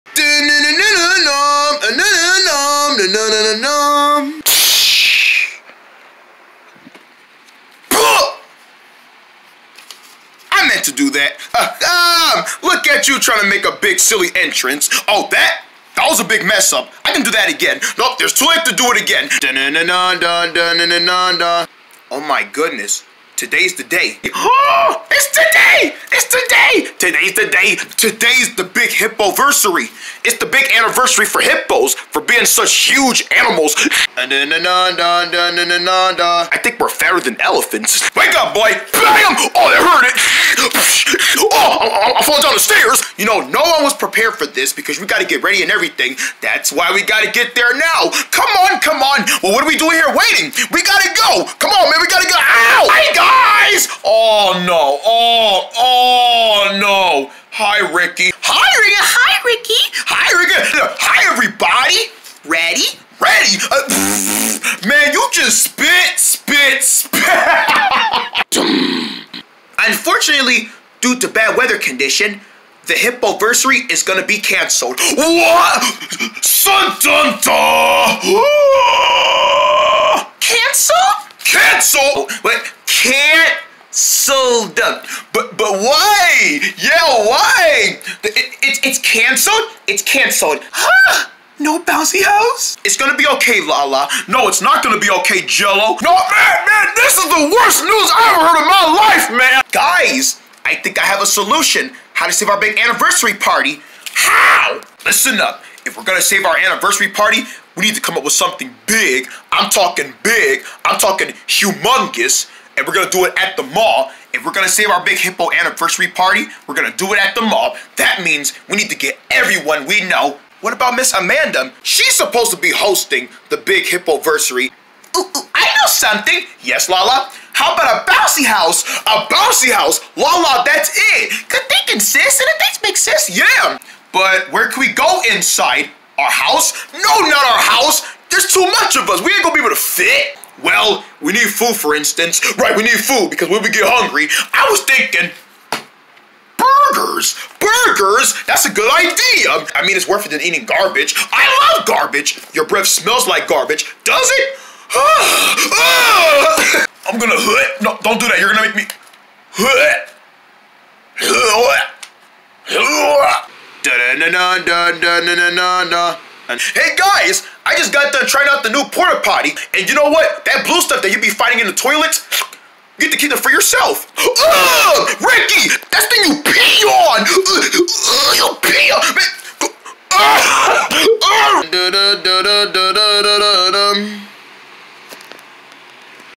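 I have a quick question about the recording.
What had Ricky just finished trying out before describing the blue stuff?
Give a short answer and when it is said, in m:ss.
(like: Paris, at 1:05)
The new porta potty, at 2:48.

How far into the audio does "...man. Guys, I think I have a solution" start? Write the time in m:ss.
1:39.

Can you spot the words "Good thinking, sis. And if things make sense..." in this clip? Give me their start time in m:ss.
2:11.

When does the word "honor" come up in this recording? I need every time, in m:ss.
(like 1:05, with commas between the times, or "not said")
not said.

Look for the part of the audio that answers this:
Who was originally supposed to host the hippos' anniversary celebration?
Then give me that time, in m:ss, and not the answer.
2:00.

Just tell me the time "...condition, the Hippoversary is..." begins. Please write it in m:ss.
1:11.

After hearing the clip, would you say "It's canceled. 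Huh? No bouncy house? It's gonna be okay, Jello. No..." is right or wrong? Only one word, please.
wrong.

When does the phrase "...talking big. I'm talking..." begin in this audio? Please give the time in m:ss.
1:49.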